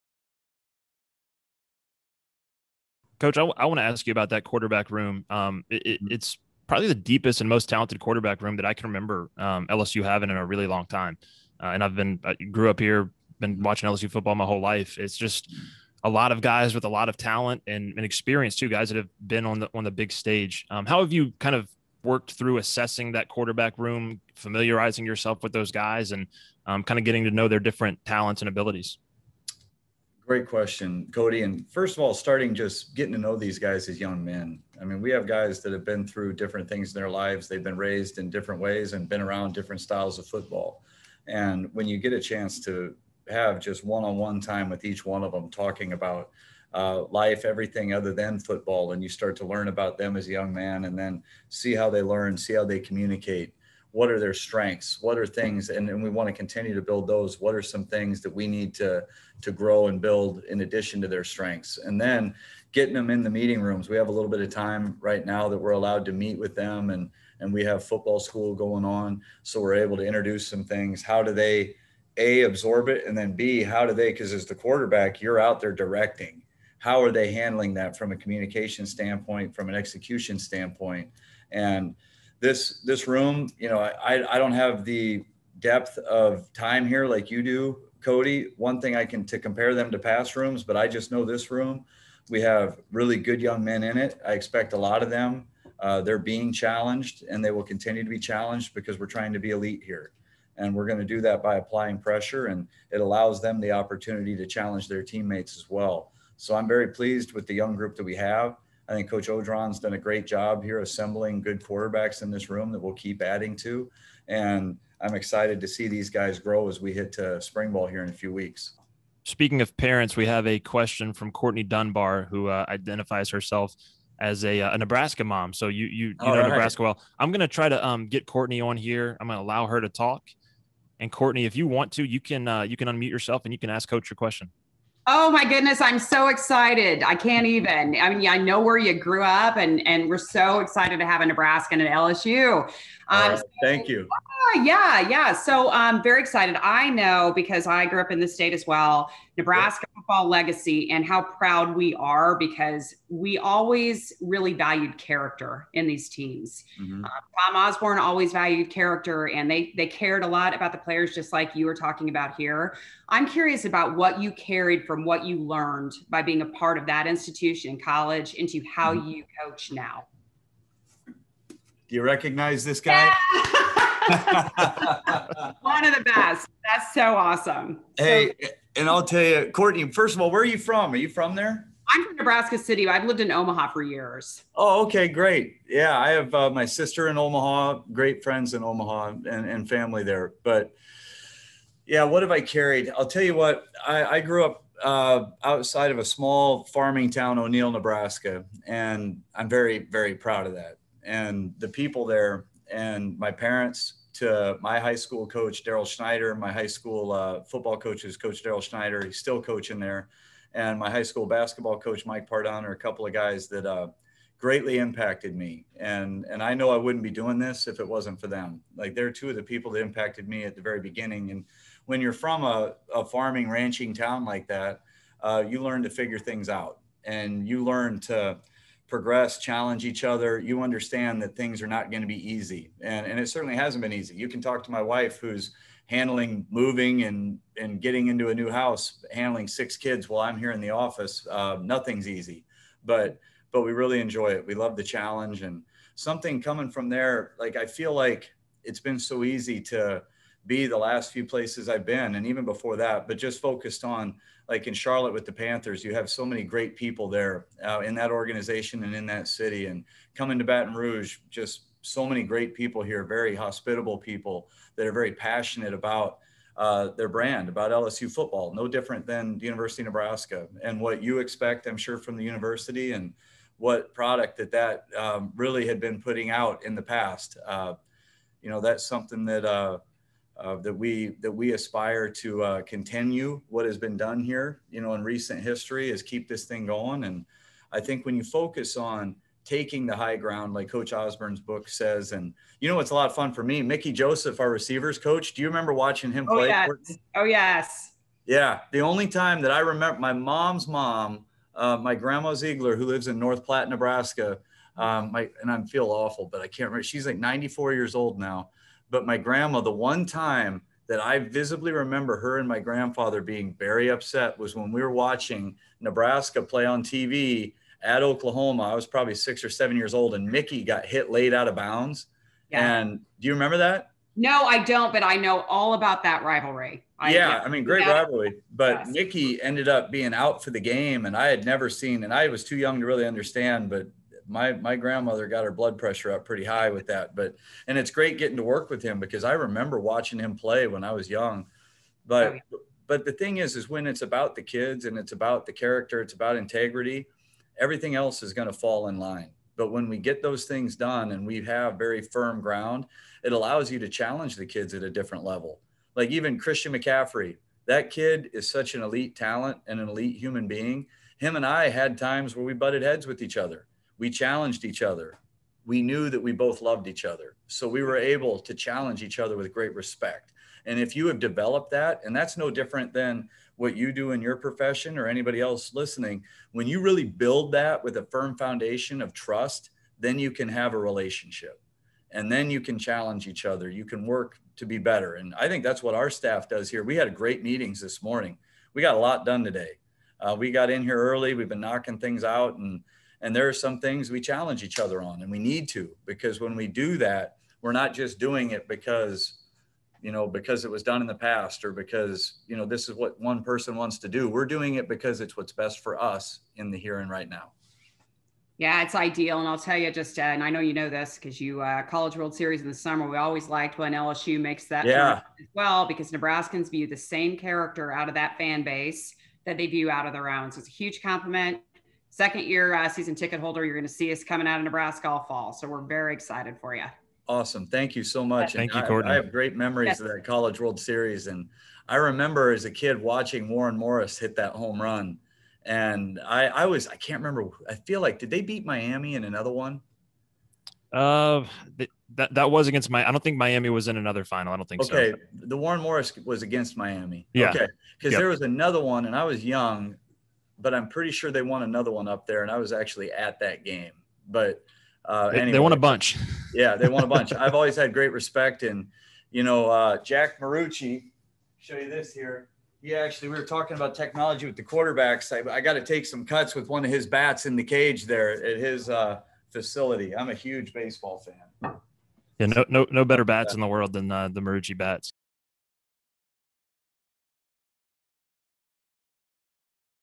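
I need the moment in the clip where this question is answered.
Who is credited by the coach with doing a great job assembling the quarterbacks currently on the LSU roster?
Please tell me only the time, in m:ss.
1:49.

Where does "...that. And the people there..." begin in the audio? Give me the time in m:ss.
3:20.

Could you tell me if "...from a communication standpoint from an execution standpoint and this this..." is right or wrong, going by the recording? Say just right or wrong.
right.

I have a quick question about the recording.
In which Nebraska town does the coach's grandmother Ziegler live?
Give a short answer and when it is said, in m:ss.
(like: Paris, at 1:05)
North Platte, at 5:03.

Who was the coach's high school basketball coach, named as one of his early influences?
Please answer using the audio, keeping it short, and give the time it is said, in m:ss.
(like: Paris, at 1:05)
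Mike Pardon, at 3:32.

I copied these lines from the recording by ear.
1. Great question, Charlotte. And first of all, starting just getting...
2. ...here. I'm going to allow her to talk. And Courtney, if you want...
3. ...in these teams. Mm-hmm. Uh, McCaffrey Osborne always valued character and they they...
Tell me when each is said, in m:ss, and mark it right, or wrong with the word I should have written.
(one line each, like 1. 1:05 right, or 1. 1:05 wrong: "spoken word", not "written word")
1. 0:30 wrong: "Cody", not "Charlotte"
2. 2:08 right
3. 2:35 wrong: "Tom", not "McCaffrey".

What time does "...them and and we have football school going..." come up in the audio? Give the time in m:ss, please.
1:06.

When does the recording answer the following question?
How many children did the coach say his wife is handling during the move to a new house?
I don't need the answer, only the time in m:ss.
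3:59.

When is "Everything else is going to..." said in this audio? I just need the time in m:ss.
5:47.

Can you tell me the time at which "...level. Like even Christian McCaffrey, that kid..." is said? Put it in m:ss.
5:55.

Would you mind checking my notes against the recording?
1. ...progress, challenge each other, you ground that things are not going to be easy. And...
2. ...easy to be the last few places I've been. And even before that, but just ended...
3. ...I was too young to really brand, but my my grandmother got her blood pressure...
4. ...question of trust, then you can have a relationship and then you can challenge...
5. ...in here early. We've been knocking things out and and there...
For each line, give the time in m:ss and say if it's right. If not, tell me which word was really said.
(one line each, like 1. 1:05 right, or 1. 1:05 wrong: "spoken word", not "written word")
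1. 3:48 wrong: "understand", not "ground"
2. 4:09 wrong: "focused", not "ended"
3. 5:32 wrong: "understand", not "brand"
4. 6:18 wrong: "foundation", not "question"
5. 6:30 right.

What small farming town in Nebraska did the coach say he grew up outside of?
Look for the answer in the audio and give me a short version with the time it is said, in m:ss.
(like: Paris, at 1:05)
O'Neill, Nebraska, at 3:17.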